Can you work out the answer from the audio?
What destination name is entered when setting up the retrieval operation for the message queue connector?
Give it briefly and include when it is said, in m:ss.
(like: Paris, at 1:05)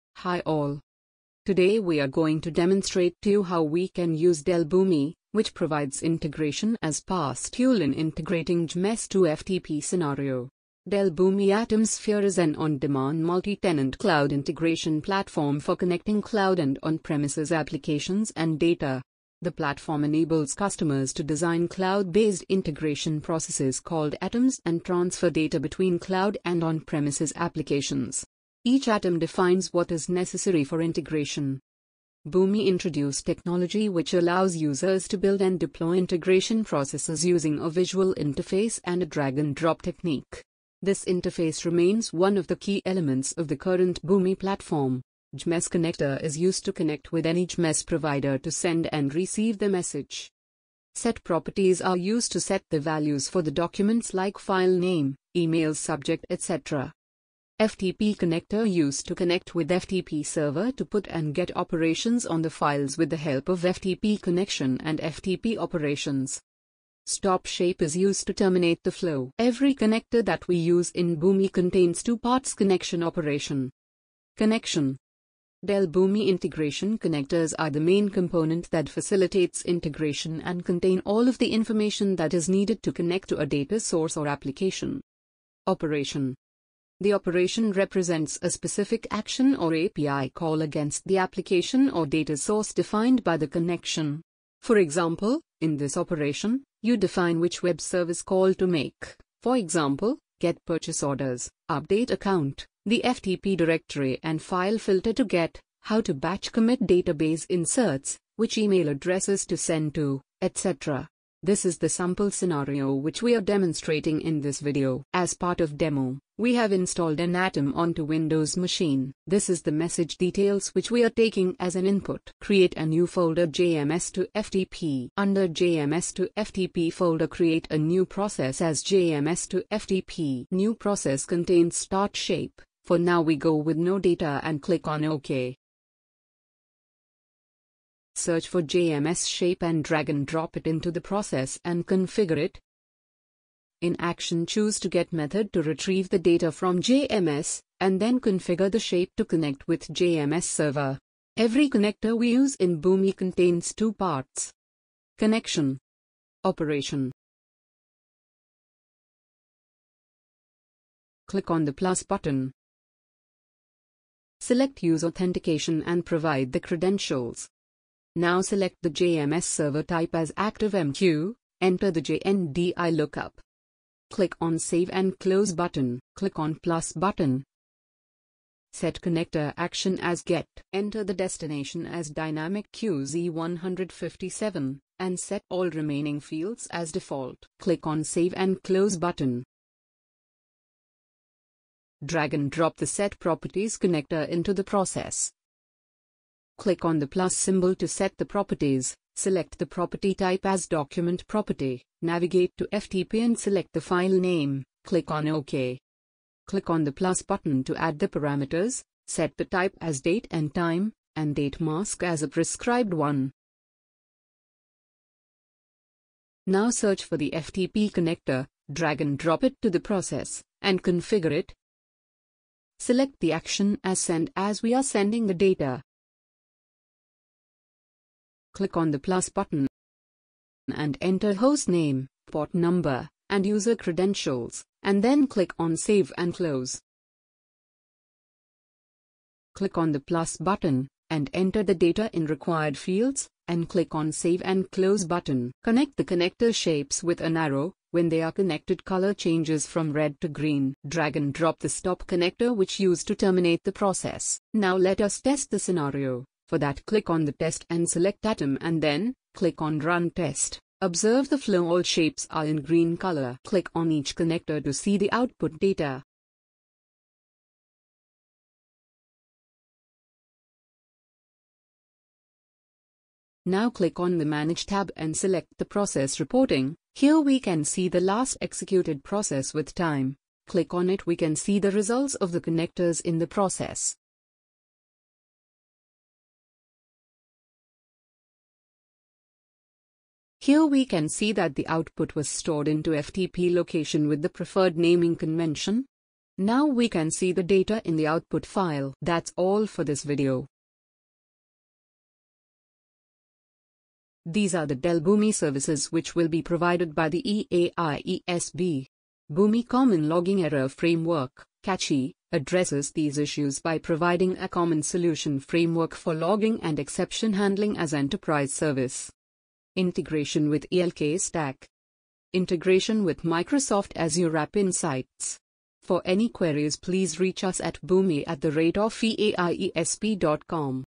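Dynamic QZ157, at 3:02.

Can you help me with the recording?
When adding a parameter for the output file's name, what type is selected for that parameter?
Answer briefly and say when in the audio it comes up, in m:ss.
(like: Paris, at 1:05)
date and time, at 3:30.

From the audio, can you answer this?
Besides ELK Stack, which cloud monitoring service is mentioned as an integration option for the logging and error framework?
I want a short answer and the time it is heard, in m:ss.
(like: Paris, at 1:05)
Microsoft Azure App Insights, at 5:23.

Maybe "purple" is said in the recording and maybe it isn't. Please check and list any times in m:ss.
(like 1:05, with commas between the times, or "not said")
not said.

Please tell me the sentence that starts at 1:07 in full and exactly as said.
Stop shape is used to terminate the flow.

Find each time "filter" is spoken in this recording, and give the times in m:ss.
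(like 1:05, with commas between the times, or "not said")
1:44.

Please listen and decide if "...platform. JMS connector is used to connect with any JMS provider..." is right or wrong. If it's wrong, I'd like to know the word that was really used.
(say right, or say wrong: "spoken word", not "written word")
right.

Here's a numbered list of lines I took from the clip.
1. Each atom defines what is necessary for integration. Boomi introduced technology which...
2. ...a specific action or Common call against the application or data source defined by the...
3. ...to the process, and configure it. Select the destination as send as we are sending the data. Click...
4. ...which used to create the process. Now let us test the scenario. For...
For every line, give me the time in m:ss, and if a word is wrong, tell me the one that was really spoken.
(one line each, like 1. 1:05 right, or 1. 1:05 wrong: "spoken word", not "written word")
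1. 0:28 right
2. 1:28 wrong: "API", not "Common"
3. 3:39 wrong: "action", not "destination"
4. 4:12 wrong: "terminate", not "create".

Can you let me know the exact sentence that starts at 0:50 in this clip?
Set properties are used to set the values for the documents like file name, email subject, etc.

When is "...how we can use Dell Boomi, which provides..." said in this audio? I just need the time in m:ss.
0:03.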